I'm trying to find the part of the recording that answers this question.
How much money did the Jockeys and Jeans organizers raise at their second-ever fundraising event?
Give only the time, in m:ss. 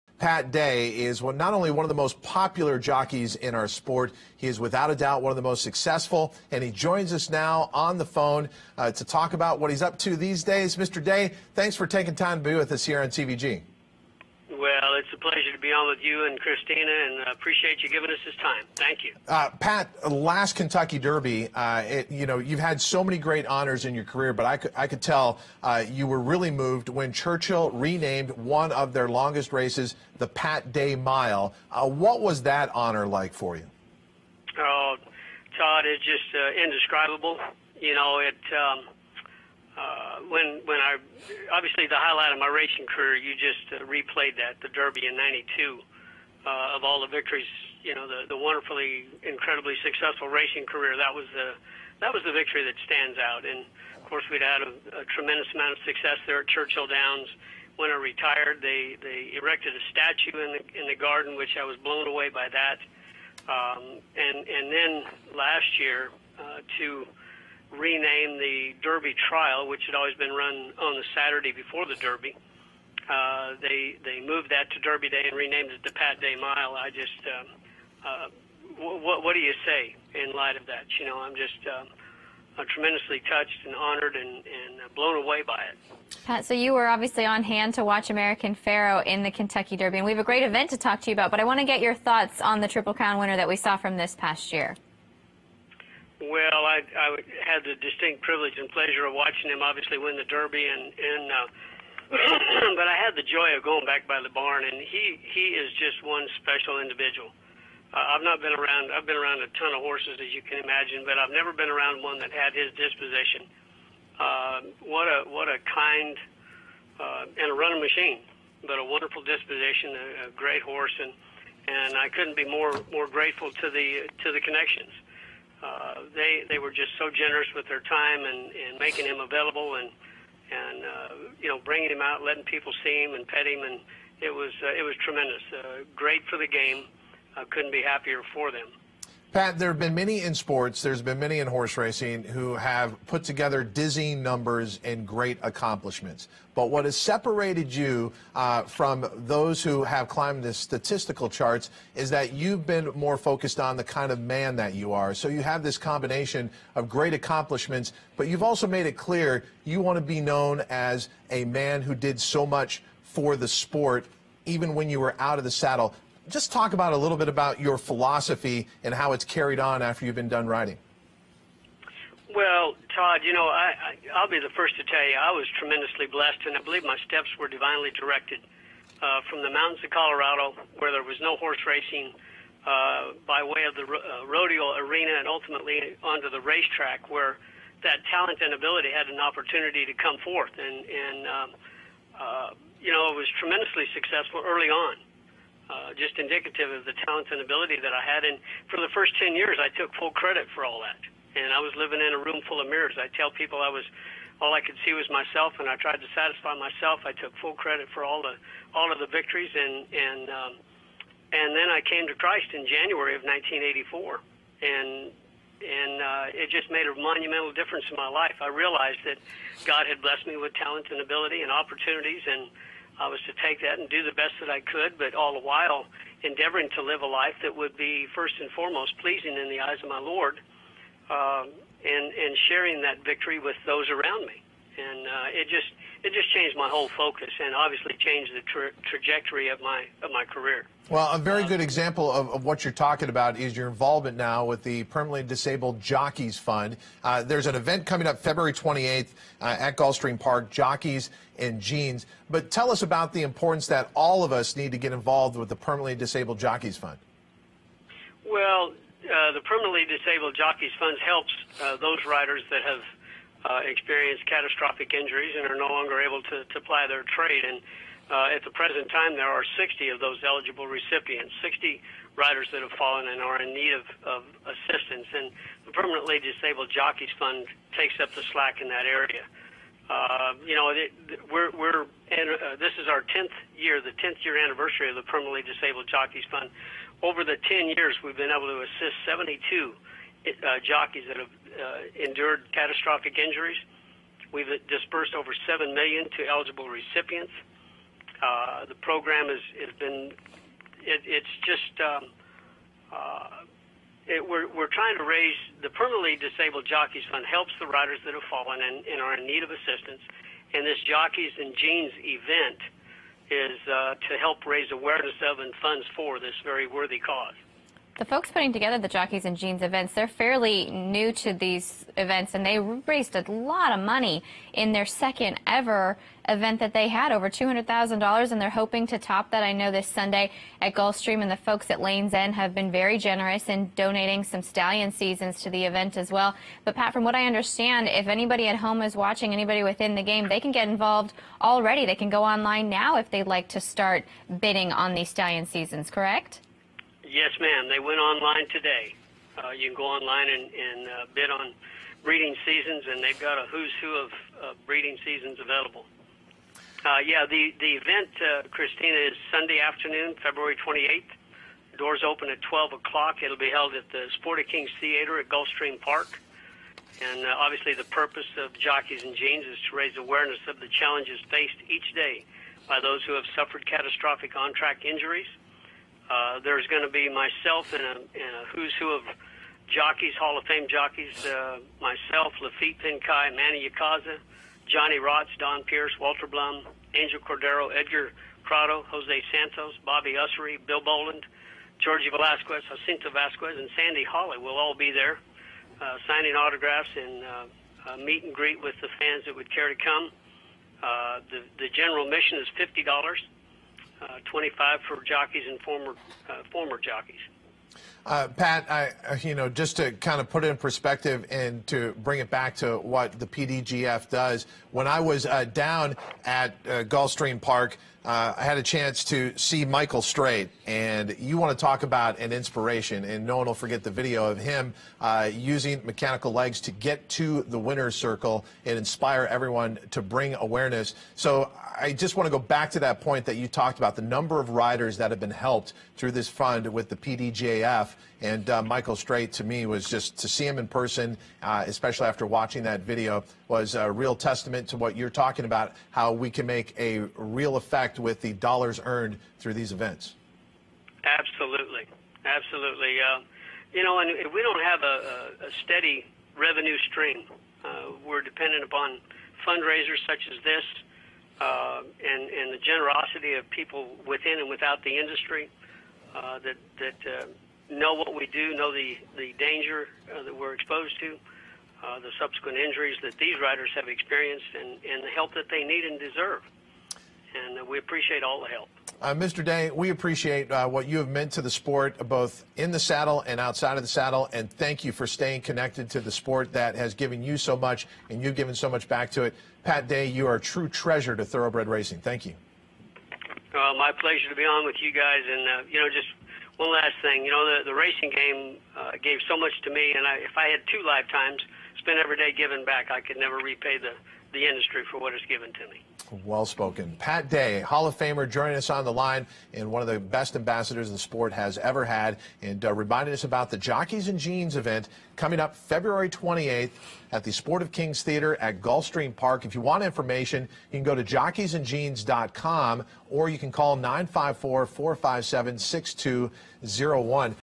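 5:27.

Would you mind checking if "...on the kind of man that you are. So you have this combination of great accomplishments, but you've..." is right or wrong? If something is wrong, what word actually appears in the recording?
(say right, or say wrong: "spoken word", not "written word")
right.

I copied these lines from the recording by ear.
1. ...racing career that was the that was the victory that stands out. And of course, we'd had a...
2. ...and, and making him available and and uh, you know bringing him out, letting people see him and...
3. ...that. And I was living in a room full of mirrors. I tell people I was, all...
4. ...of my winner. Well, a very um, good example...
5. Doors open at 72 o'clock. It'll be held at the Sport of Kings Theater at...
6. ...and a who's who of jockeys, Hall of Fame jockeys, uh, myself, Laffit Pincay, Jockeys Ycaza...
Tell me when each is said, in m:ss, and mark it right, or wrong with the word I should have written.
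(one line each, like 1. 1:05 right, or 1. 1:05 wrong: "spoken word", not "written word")
1. 0:50 right
2. 2:08 right
3. 3:20 right
4. 4:00 wrong: "career", not "winner"
5. 6:01 wrong: "12", not "72"
6. 6:17 wrong: "Manny", not "Jockeys".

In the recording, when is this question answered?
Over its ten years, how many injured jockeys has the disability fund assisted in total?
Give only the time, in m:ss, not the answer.
4:49.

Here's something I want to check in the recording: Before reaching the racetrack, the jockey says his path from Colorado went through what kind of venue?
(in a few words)
Rodeo arena.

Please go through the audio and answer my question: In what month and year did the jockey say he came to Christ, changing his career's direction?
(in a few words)
January 1984.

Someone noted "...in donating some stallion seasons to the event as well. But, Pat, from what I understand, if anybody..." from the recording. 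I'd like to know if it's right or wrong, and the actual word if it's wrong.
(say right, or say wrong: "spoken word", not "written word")
right.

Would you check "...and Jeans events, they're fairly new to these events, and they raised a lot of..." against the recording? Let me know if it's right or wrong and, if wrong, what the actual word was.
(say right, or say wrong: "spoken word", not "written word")
right.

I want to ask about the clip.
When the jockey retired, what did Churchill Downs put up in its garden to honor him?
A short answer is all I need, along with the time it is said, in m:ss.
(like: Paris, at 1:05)
A statue, at 0:59.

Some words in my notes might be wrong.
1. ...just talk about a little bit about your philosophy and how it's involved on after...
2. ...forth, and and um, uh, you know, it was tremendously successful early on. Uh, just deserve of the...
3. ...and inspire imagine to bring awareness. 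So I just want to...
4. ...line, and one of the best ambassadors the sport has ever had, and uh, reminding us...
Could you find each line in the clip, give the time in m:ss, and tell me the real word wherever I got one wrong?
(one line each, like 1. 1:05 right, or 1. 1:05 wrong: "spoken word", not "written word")
1. 2:46 wrong: "carried", not "involved"
2. 3:10 wrong: "indicative", not "deserve"
3. 7:08 wrong: "everyone", not "imagine"
4. 8:28 right.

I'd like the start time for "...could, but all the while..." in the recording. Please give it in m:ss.
3:44.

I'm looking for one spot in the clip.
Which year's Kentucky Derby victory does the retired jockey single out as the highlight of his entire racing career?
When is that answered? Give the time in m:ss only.
0:45.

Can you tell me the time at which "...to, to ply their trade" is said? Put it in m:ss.
4:26.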